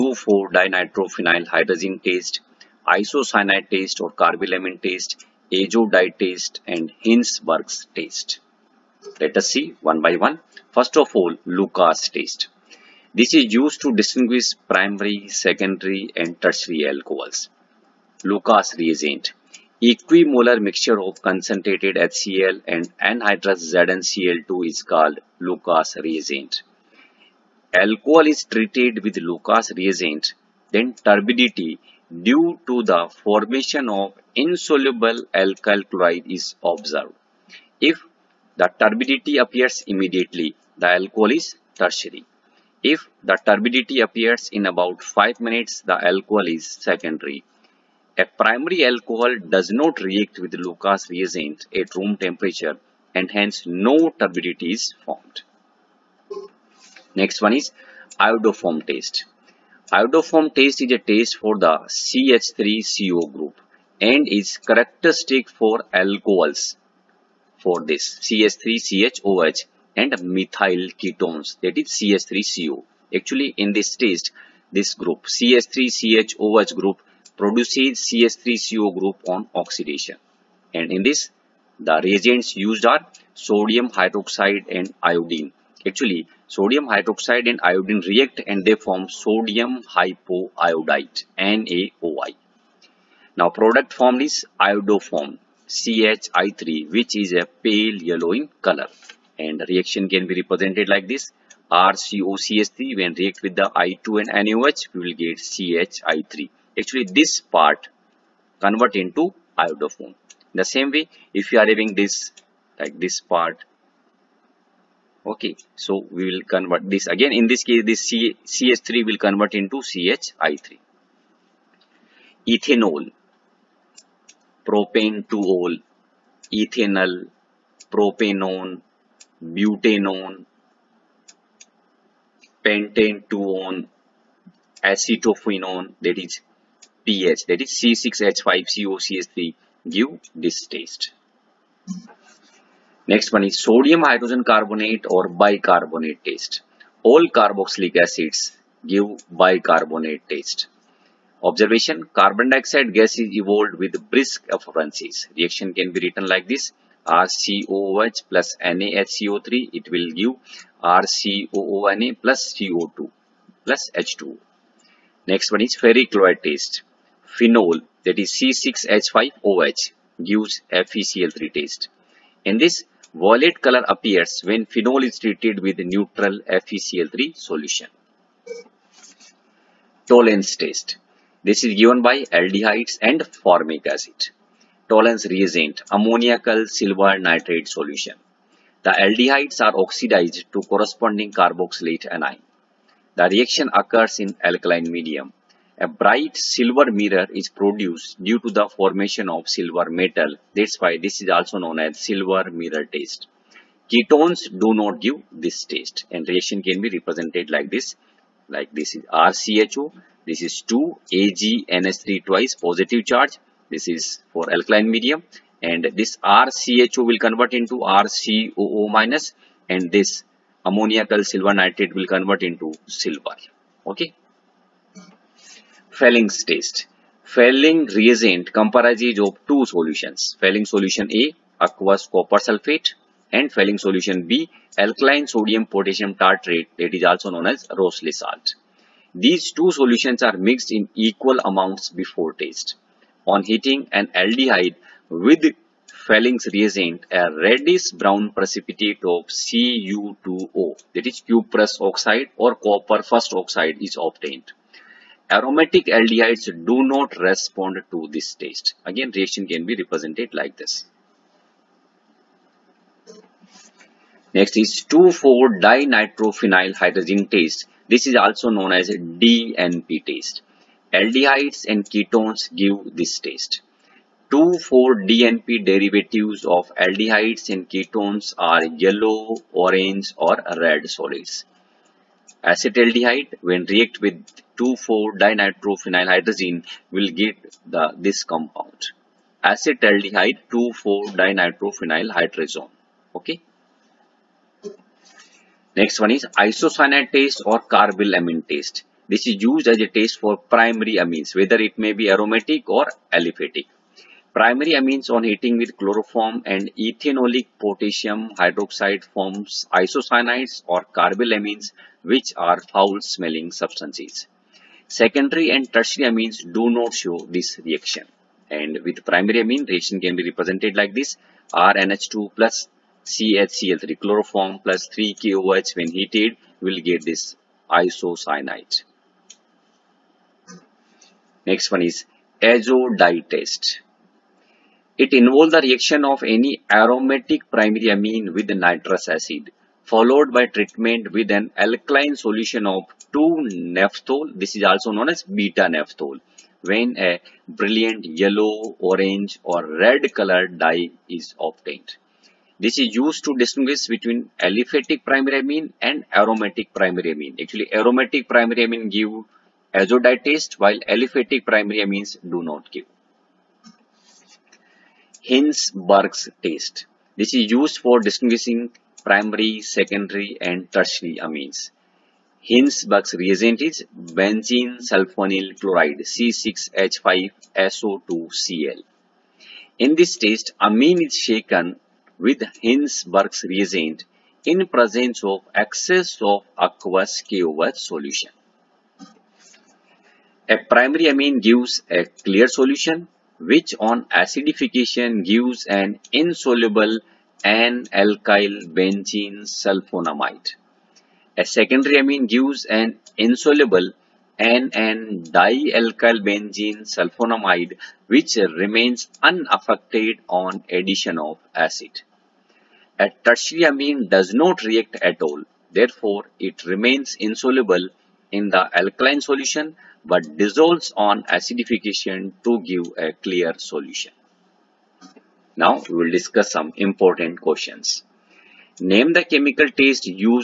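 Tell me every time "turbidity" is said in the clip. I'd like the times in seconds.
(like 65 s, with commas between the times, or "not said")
31 s, 38 s, 43 s, 54 s.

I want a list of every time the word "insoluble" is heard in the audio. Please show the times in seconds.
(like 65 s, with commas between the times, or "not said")
34 s, 396 s, 403 s, 417 s.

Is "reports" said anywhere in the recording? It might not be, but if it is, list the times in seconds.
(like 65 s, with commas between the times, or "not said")
not said.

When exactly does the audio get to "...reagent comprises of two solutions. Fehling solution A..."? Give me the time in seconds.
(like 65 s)
227 s.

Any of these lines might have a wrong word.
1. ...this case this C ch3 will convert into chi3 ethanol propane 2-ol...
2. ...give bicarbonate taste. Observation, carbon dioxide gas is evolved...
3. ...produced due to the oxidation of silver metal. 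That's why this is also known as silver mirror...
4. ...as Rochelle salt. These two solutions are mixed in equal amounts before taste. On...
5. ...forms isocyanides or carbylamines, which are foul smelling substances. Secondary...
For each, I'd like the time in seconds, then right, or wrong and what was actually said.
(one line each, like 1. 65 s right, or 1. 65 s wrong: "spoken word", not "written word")
1. 117 s right
2. 148 s right
3. 197 s wrong: "formation", not "oxidation"
4. 237 s right
5. 309 s right.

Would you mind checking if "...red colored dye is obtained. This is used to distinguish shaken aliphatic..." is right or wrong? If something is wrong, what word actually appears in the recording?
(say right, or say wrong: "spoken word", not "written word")
wrong: "between", not "shaken".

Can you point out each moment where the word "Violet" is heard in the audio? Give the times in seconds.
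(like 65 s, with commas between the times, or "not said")
173 s.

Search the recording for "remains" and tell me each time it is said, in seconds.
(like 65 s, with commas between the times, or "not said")
408 s, 416 s.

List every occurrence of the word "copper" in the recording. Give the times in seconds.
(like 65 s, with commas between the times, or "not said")
232 s, 252 s.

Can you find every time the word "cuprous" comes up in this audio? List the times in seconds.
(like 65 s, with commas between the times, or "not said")
251 s.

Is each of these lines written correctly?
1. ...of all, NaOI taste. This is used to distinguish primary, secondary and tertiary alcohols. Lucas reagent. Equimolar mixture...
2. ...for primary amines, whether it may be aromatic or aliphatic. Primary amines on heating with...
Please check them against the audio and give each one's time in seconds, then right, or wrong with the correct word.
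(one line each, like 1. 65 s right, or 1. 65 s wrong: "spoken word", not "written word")
1. 10 s wrong: "Lucas", not "NaOI"
2. 300 s right.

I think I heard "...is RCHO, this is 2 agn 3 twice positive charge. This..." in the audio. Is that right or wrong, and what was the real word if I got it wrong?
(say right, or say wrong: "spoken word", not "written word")
right.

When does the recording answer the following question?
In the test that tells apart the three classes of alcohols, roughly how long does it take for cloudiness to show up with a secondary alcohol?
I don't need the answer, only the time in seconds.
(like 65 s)
45 s.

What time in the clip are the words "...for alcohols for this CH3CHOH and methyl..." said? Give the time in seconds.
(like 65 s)
65 s.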